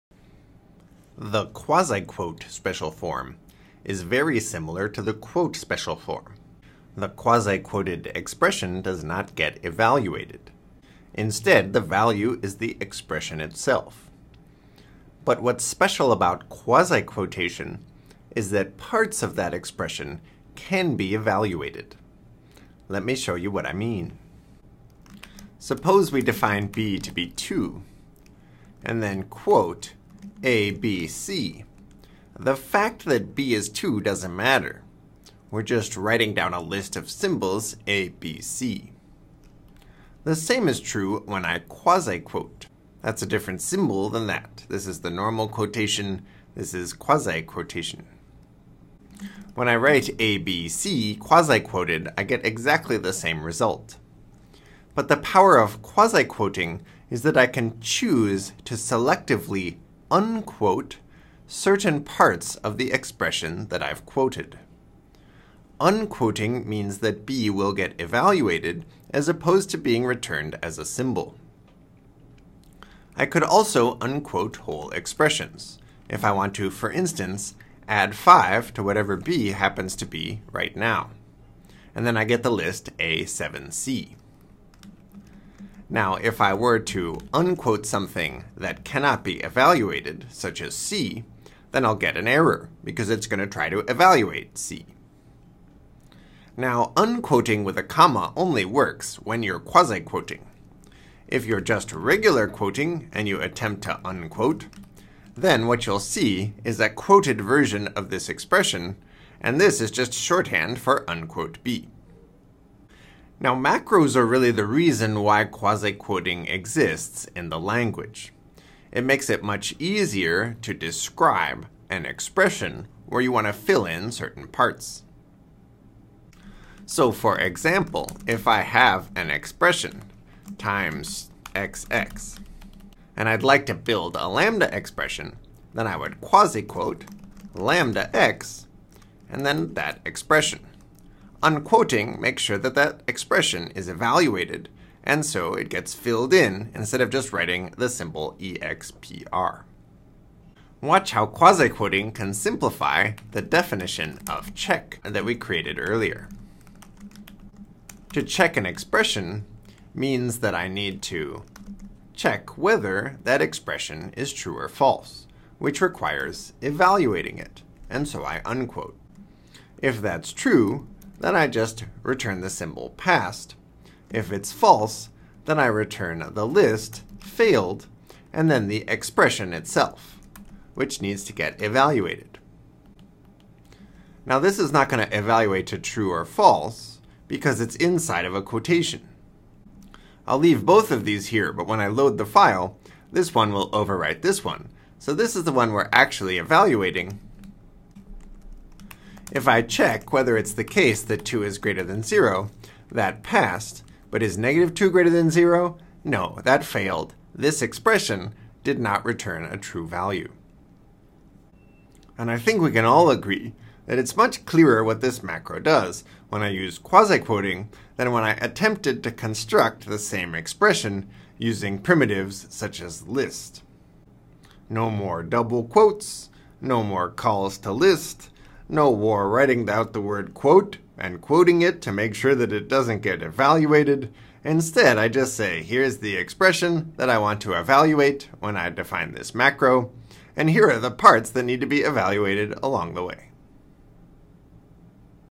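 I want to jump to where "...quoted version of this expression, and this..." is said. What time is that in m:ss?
1:46.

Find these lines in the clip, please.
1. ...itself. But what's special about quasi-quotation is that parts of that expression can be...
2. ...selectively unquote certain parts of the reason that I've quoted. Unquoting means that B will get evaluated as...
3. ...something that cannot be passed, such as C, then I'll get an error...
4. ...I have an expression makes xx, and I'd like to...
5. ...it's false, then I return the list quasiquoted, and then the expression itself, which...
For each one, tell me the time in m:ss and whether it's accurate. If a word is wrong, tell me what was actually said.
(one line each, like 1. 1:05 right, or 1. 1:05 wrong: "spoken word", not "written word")
1. 0:13 right
2. 0:58 wrong: "expression", not "reason"
3. 1:27 wrong: "evaluated", not "passed"
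4. 2:08 wrong: "times", not "makes"
5. 2:54 wrong: "failed", not "quasiquoted".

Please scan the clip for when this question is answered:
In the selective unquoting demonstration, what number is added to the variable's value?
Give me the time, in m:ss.
1:18.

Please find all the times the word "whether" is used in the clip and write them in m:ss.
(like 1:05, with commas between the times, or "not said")
2:42, 3:20.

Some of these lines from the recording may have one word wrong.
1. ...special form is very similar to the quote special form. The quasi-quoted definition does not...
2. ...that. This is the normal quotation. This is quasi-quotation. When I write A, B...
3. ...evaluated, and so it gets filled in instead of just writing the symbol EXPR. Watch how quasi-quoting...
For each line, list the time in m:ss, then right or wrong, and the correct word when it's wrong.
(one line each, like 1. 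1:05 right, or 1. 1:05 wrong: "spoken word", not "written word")
1. 0:02 wrong: "expression", not "definition"
2. 0:44 right
3. 2:23 right.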